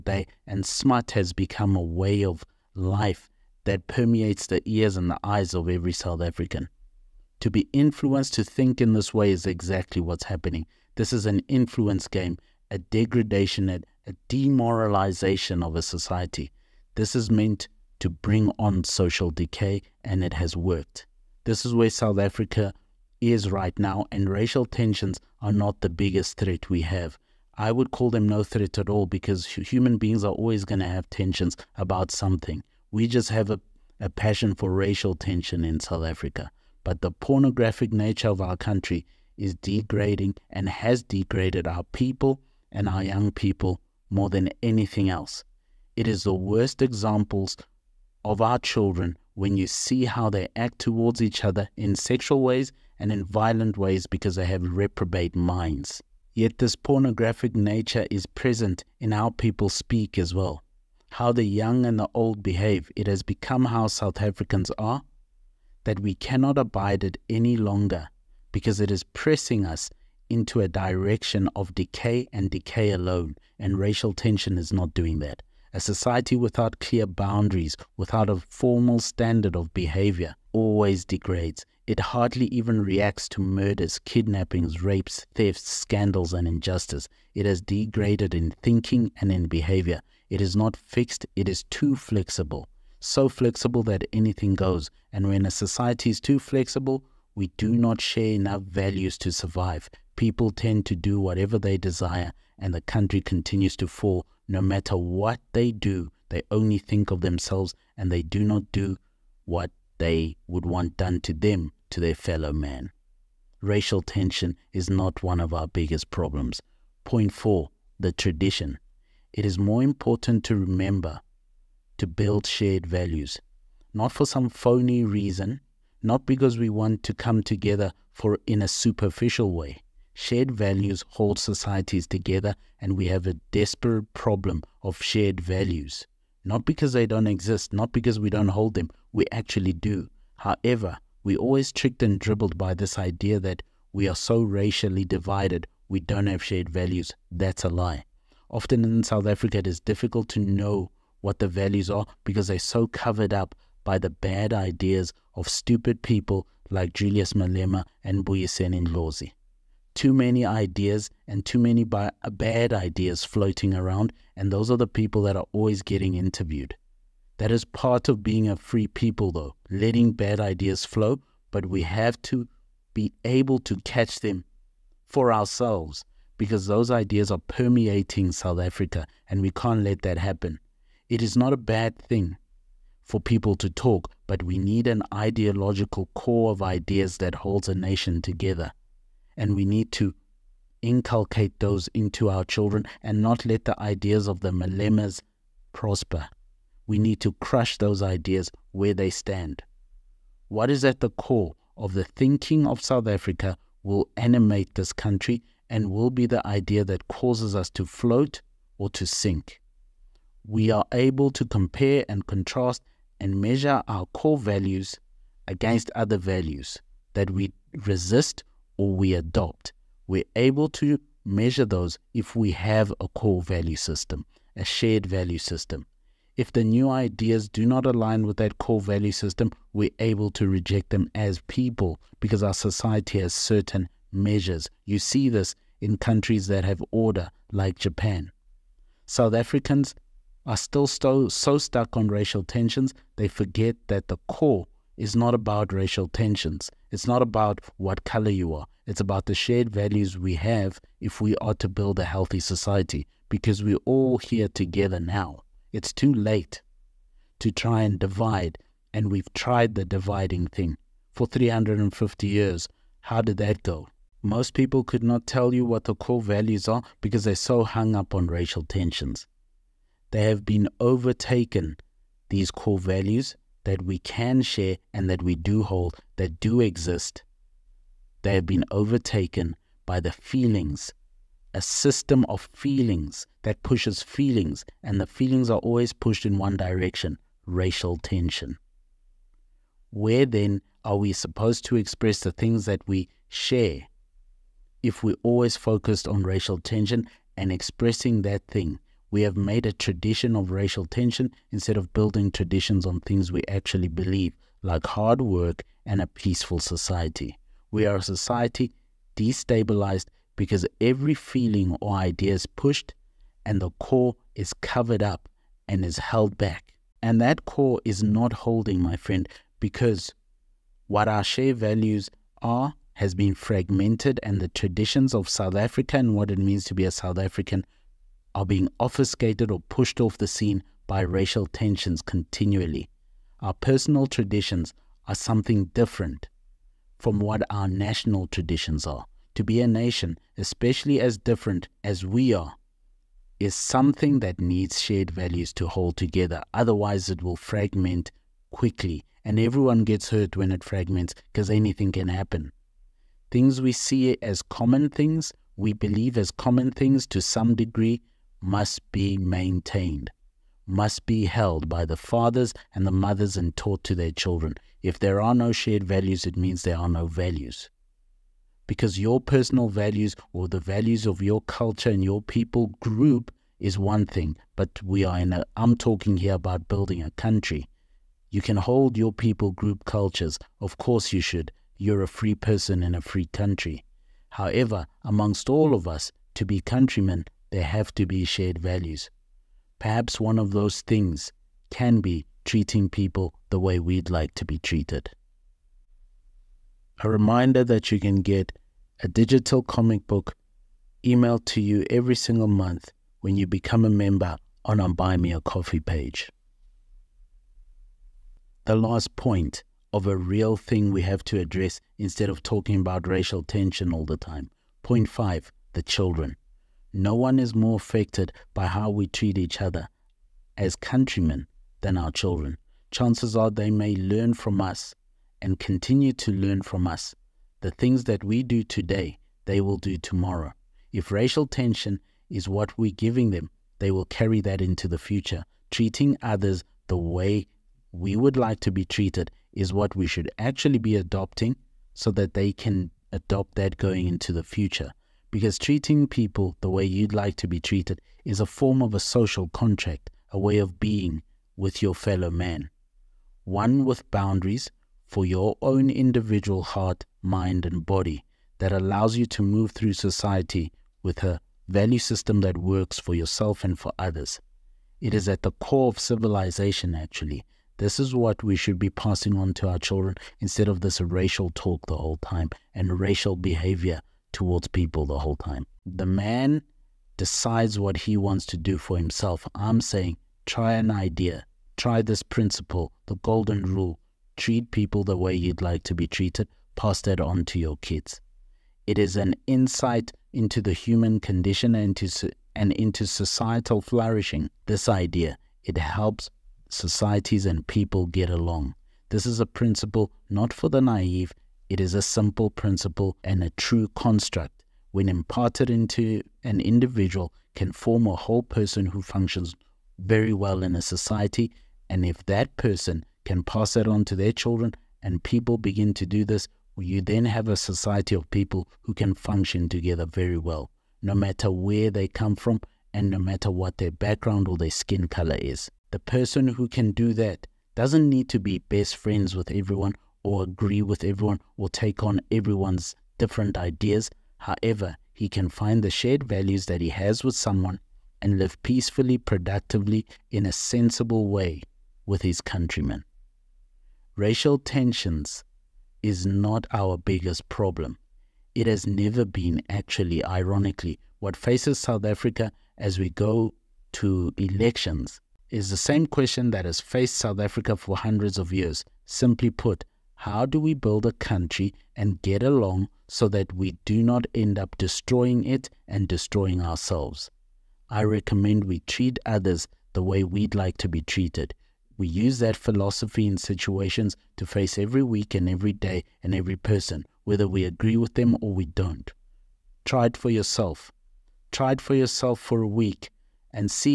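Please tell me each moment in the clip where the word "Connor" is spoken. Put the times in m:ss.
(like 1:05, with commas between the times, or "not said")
not said.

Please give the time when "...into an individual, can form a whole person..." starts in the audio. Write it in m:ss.
8:25.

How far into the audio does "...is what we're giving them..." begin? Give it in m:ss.
7:12.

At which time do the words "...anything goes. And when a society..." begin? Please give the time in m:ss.
1:34.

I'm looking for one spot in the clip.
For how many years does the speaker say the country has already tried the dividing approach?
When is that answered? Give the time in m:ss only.
4:21.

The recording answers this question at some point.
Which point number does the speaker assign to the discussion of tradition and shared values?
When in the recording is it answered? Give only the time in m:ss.
1:57.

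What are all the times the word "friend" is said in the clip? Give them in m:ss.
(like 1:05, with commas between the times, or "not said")
5:18, 8:48.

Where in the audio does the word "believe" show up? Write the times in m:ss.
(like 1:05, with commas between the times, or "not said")
5:03, 5:55.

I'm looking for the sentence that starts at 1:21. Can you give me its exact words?
It hardly even reacts to murders, kidnappings, rapes, thefts, scandals, and injustice.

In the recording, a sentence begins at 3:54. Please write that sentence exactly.
You see this in countries that have order, like Japan.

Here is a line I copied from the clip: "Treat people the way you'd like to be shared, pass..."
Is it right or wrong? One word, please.
wrong.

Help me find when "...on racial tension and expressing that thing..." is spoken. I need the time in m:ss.
4:56.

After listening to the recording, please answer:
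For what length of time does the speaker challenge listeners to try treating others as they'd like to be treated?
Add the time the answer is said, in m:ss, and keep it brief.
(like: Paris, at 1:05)
A week, at 9:42.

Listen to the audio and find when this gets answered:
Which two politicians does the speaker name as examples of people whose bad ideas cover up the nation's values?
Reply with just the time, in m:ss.
2:36.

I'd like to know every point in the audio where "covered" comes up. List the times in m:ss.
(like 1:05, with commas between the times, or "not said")
2:32, 5:14.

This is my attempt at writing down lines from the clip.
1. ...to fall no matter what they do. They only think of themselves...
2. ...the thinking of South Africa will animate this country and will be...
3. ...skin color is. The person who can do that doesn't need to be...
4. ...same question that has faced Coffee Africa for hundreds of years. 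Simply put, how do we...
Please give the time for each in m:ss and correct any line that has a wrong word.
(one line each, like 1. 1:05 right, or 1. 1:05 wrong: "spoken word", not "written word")
1. 1:43 right
2. 3:21 right
3. 8:44 right
4. 9:15 wrong: "South", not "Coffee".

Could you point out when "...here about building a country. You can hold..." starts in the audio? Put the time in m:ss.
6:16.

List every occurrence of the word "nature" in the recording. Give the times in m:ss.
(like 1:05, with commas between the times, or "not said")
0:37, 0:57.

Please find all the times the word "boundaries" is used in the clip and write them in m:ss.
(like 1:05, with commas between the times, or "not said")
1:17, 7:34.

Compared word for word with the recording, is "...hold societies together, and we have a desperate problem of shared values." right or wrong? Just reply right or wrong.
right.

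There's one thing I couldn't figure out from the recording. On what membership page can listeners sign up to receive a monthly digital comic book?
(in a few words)
Buy Me a Coffee.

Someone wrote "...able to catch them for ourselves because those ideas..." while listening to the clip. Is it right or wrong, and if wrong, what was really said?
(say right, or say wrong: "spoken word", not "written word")
right.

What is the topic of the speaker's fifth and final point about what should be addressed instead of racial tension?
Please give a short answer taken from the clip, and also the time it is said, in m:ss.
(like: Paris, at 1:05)
The children, at 6:55.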